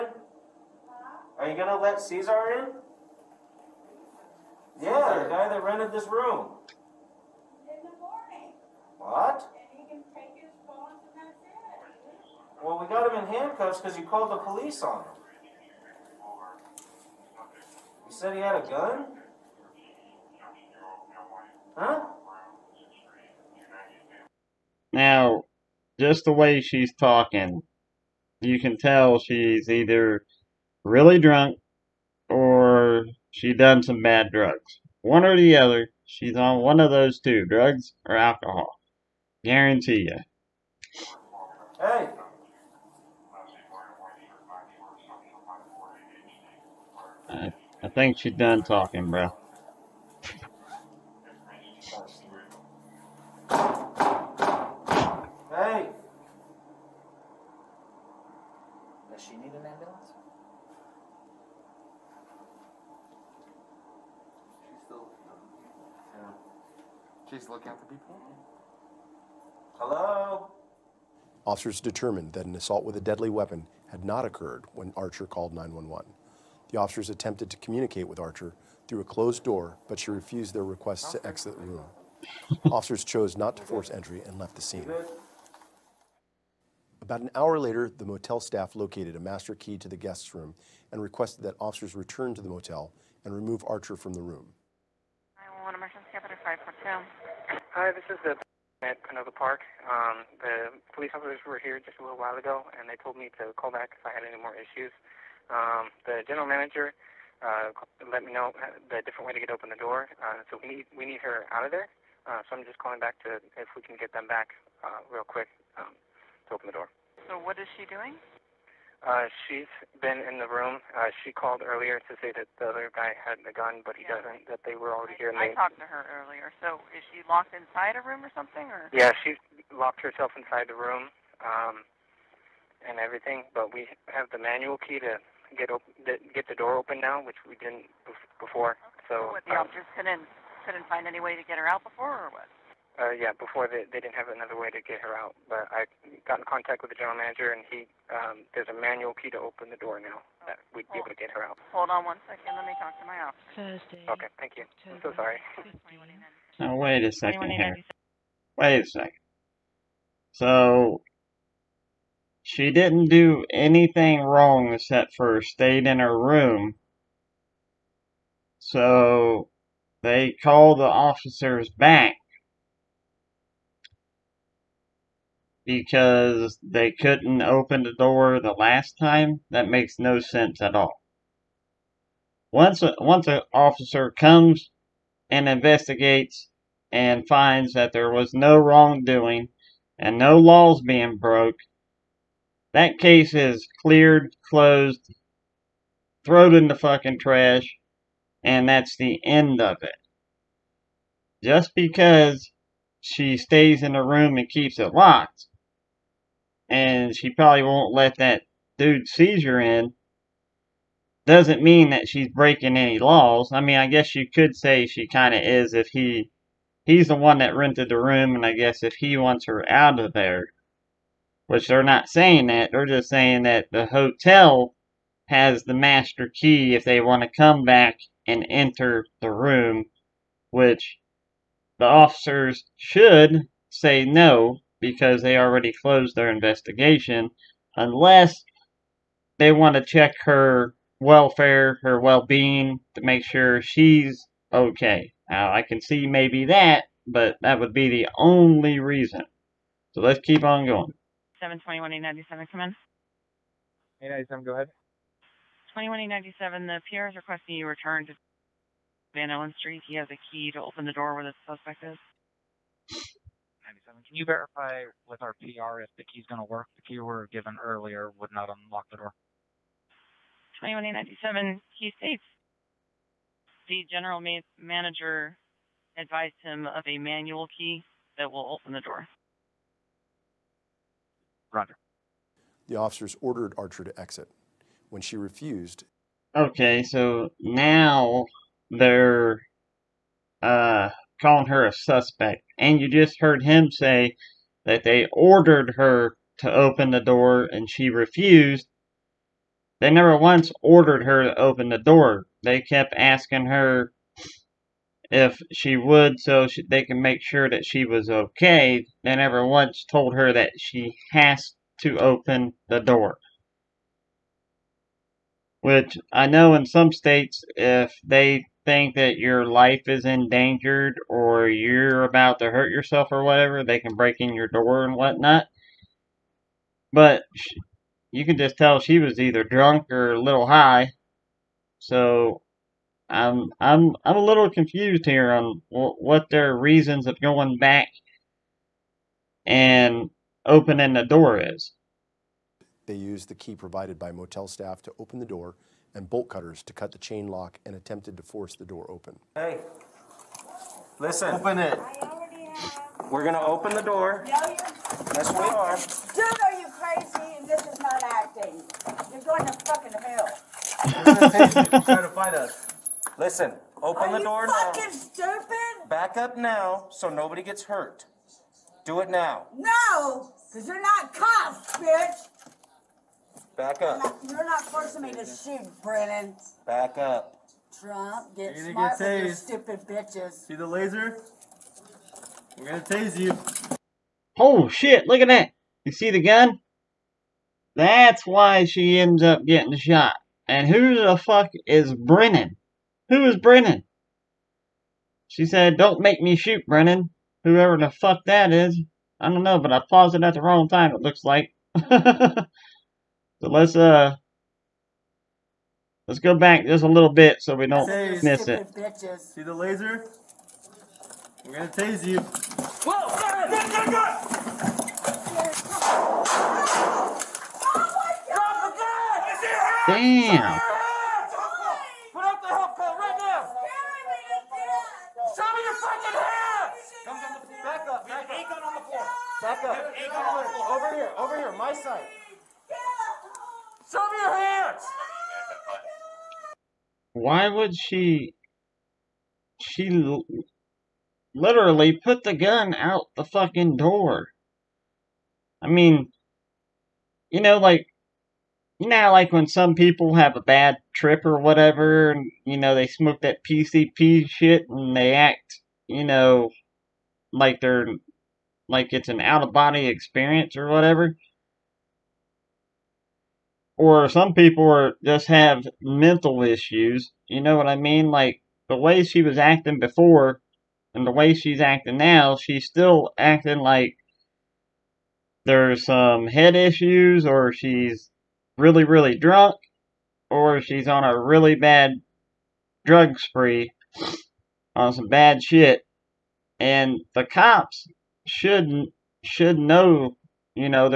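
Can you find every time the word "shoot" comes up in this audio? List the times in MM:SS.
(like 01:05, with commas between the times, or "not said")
06:15, 06:36.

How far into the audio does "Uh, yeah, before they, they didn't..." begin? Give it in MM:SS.
02:22.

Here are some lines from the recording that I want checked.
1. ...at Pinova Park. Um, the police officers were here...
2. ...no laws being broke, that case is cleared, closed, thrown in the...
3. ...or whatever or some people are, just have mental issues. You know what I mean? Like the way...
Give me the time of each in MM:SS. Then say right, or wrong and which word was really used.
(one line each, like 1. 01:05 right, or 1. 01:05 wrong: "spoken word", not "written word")
1. 01:38 right
2. 03:10 right
3. 07:40 right.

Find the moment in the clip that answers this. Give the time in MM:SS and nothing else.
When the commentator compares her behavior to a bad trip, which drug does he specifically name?
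07:33.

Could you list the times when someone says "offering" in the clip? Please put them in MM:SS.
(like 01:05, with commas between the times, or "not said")
not said.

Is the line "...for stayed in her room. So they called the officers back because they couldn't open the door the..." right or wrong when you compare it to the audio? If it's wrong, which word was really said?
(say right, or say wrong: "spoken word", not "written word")
right.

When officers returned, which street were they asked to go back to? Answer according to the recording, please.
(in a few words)
Van Allen Street.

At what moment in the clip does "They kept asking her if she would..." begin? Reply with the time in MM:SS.
05:02.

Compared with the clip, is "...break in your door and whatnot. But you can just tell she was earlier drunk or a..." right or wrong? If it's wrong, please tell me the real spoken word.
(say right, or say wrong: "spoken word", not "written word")
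wrong: "either", not "earlier".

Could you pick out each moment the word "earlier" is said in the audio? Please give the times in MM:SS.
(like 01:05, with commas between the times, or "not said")
02:01, 02:06, 04:27.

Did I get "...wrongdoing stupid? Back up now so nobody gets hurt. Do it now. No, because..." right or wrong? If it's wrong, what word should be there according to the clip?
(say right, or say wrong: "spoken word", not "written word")
wrong: "fucking", not "wrongdoing".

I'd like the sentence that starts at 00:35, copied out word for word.
One or the other, she's on one of those two, drugs or alcohol.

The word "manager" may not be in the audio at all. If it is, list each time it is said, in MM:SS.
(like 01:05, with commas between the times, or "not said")
01:46, 02:27, 04:34.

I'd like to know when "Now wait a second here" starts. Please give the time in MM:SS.
02:36.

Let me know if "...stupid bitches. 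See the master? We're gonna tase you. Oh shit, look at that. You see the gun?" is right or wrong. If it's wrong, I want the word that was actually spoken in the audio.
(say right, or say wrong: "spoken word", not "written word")
wrong: "laser", not "master".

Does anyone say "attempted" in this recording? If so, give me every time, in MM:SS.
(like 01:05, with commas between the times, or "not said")
01:17, 05:47.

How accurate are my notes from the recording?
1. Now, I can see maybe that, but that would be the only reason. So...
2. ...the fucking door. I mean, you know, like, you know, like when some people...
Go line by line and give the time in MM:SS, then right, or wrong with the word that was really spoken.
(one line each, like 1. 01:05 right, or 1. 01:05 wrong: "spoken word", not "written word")
1. 04:05 right
2. 07:23 right.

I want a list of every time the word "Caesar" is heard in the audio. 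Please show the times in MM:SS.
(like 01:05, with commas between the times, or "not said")
00:01, 03:29.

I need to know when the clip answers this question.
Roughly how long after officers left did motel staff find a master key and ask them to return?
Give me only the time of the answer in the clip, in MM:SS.
01:27.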